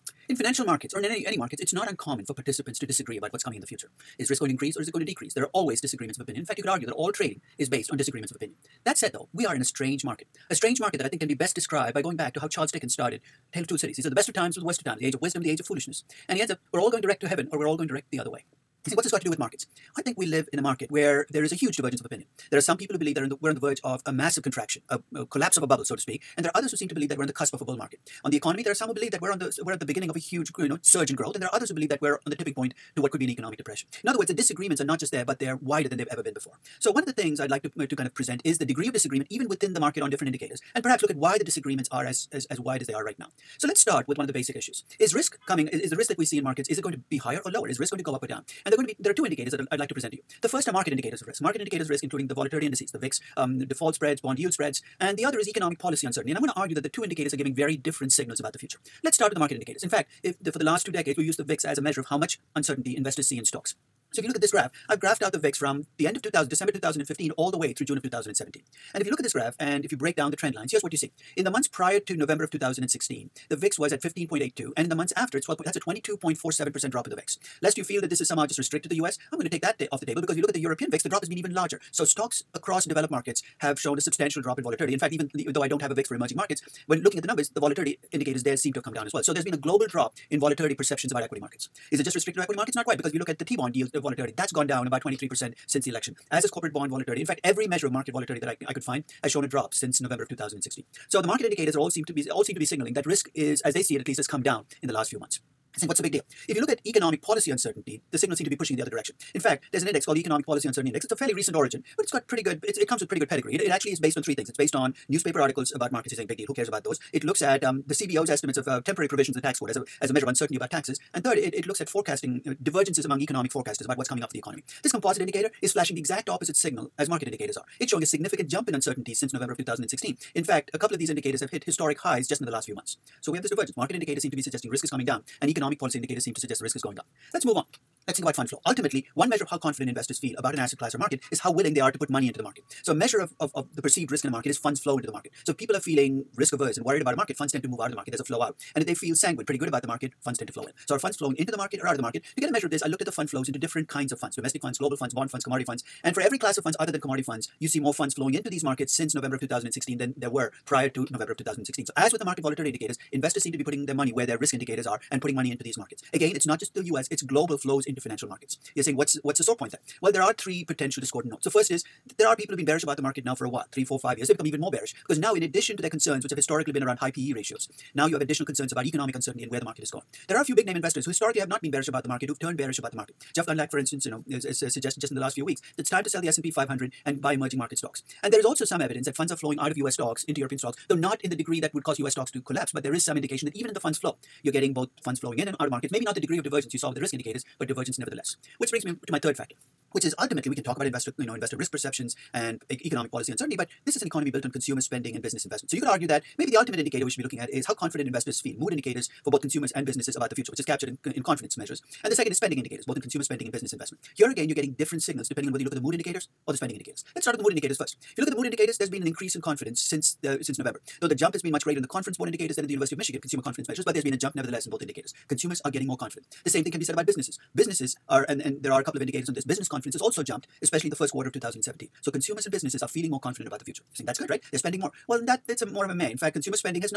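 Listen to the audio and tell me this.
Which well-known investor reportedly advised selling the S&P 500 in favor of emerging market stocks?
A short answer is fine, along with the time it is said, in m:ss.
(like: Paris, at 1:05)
Jeff Gundlach, at 3:03.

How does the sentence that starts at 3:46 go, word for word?
The same thing can be said about businesses.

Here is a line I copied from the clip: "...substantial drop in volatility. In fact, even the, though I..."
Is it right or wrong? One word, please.
right.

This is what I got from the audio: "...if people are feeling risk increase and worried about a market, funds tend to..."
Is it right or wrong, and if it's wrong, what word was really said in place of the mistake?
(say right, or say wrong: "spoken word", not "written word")
wrong: "averse", not "increase".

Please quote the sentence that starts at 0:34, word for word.
In other words, the disagreements are not just there, but they're wider than they've ever been before.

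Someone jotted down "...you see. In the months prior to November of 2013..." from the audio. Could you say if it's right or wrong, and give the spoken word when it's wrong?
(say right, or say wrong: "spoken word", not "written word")
wrong: "2016", not "2013".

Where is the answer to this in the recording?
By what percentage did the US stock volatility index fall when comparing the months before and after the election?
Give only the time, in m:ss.
1:15.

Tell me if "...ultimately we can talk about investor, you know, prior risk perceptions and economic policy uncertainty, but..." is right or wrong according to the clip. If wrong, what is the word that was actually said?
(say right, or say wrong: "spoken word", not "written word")
wrong: "investor", not "prior".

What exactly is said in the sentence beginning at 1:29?
So there's been a global drop in volatility perceptions about equity markets.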